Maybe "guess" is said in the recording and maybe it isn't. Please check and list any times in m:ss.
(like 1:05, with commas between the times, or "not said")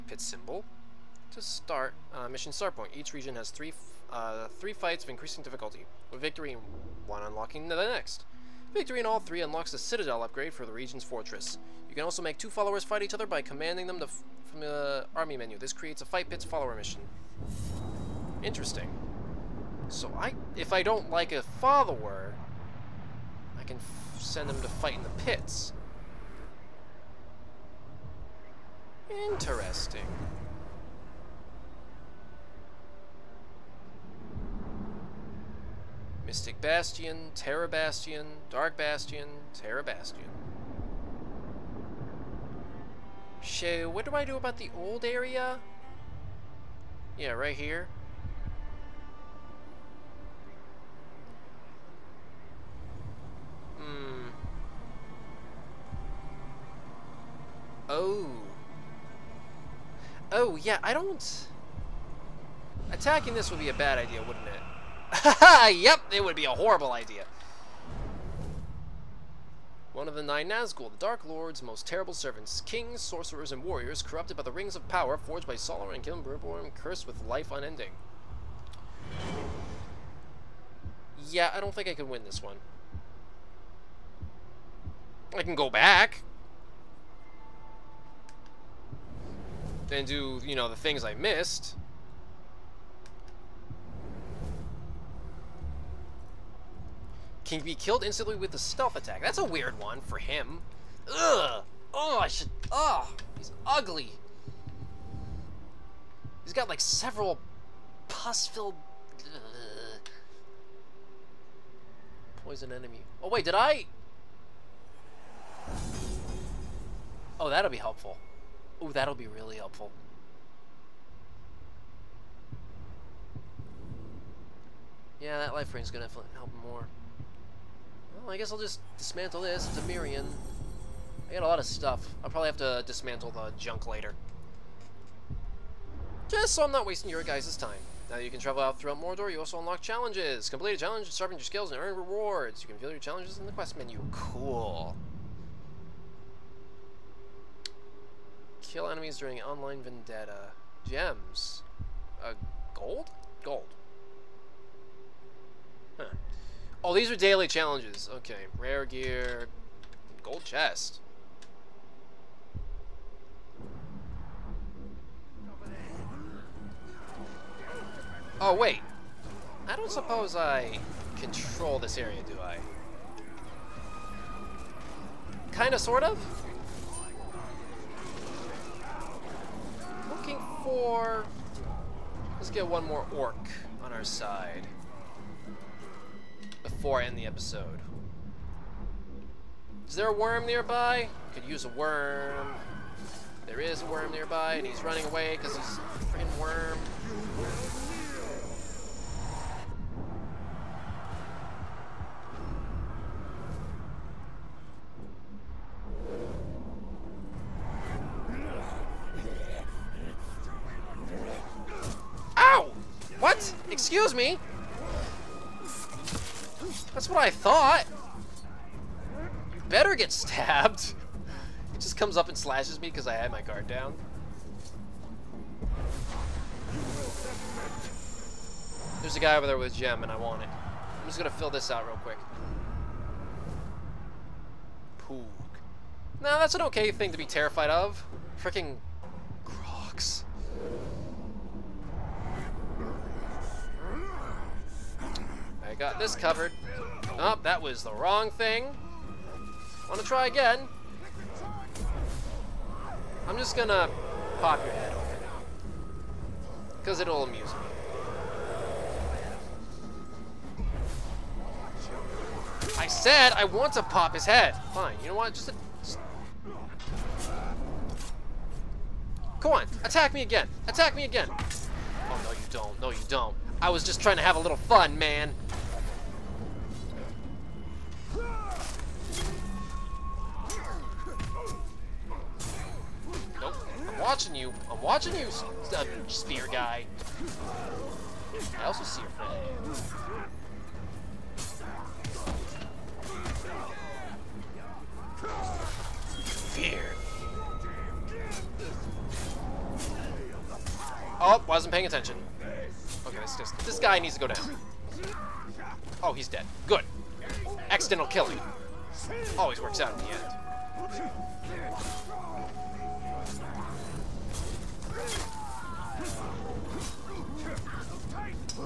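2:08.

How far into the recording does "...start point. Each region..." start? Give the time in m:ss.
0:02.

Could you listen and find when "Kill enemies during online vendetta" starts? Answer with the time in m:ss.
2:28.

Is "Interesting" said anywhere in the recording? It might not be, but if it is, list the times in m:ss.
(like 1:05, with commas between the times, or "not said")
0:18, 0:29.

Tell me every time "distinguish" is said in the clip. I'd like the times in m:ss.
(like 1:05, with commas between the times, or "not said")
not said.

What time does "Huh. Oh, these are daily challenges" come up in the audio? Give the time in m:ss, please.
2:35.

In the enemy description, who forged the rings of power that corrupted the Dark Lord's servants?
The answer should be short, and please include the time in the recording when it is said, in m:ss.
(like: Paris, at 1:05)
Sauron and Celebrimbor, at 1:15.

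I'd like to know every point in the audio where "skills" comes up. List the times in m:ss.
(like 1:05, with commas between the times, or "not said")
2:21.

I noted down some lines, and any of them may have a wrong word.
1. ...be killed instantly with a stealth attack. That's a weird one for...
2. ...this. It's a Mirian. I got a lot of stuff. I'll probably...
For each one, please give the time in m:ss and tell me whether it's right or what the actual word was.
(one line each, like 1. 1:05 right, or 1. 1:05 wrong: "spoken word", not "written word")
1. 1:37 right
2. 2:09 right.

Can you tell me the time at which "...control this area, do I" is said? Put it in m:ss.
2:51.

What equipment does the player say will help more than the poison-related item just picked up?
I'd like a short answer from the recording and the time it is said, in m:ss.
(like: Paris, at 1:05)
life ring, at 2:05.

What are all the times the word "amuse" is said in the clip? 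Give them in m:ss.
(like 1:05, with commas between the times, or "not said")
4:17.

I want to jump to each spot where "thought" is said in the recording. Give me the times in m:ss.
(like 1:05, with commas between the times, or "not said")
3:37.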